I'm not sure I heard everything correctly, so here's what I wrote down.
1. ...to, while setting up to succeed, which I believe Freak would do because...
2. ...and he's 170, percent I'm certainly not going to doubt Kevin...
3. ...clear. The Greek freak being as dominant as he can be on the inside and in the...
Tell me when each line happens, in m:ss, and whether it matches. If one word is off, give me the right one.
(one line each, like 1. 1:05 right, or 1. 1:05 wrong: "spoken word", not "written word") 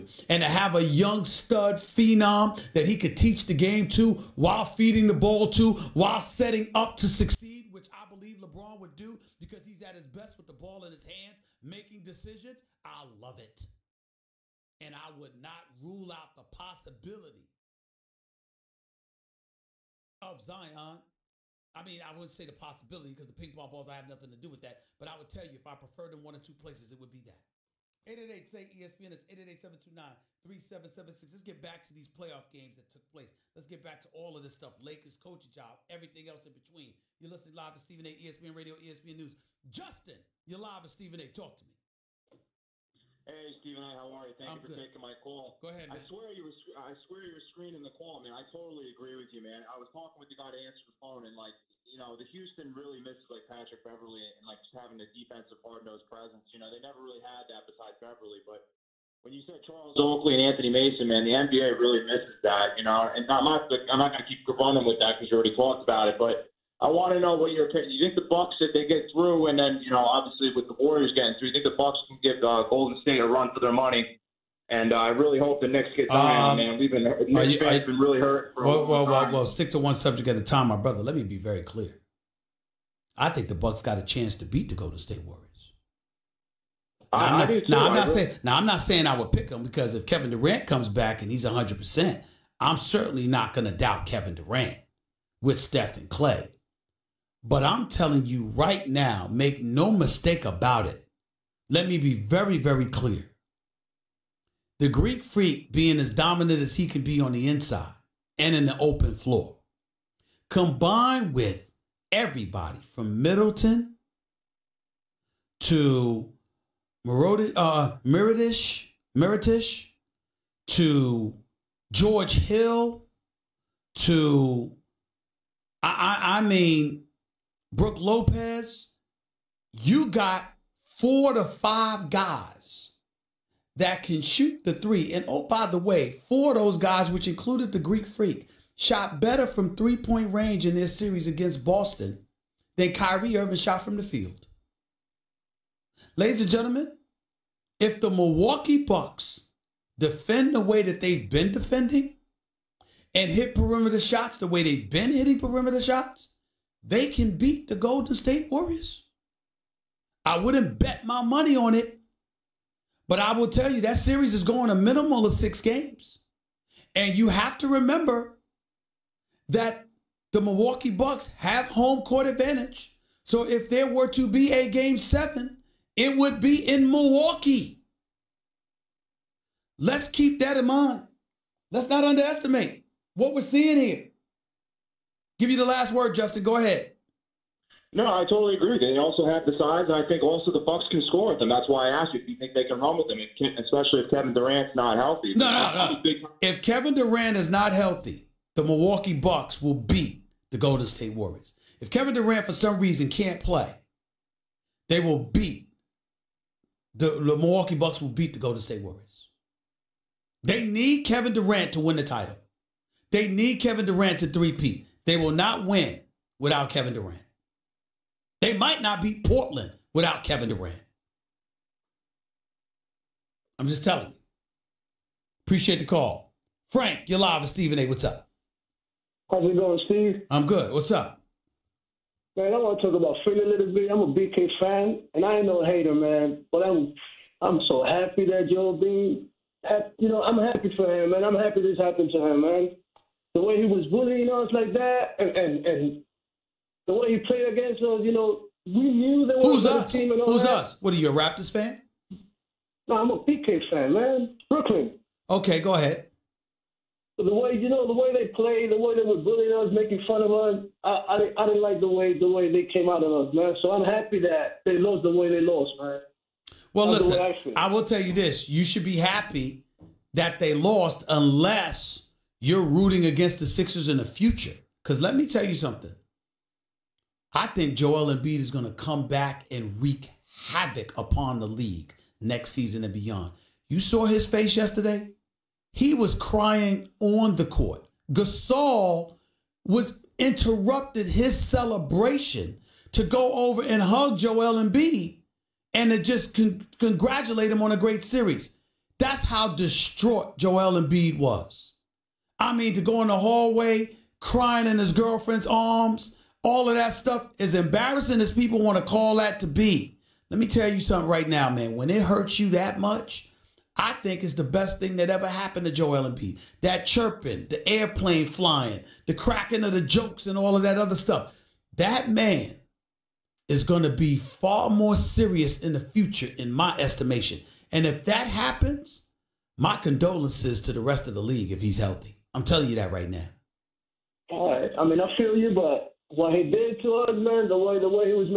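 1. 0:05 wrong: "LeBron", not "Freak"
2. 1:31 wrong: "100", not "170"
3. 1:42 right.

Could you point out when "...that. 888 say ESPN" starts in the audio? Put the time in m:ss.
0:27.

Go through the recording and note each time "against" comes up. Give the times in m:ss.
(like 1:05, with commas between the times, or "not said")
2:21, 4:07, 4:33.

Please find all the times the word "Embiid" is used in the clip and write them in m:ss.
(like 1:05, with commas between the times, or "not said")
4:38, 4:54, 5:00, 5:16.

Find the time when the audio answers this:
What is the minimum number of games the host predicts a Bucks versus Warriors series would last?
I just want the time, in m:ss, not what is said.
2:45.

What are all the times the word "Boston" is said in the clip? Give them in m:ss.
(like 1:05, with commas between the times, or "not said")
2:21.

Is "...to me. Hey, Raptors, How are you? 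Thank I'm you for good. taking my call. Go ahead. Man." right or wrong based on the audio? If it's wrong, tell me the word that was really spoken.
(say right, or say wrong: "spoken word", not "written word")
wrong: "Stephen", not "Raptors".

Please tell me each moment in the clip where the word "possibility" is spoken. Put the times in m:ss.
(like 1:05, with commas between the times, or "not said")
0:16, 0:22.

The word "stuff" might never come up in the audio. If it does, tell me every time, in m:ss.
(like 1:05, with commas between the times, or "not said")
0:34, 5:06, 5:20.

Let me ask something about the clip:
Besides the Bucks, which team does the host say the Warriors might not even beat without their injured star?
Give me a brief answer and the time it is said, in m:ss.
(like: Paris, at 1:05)
Portland, at 3:39.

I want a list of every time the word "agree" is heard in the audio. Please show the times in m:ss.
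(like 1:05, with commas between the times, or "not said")
0:48, 3:08.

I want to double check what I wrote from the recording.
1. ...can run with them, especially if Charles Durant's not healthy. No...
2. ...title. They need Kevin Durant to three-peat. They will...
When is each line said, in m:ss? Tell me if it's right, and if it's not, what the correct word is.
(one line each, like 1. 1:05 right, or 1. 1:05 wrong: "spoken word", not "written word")
1. 3:12 wrong: "Kevin", not "Charles"
2. 3:32 right.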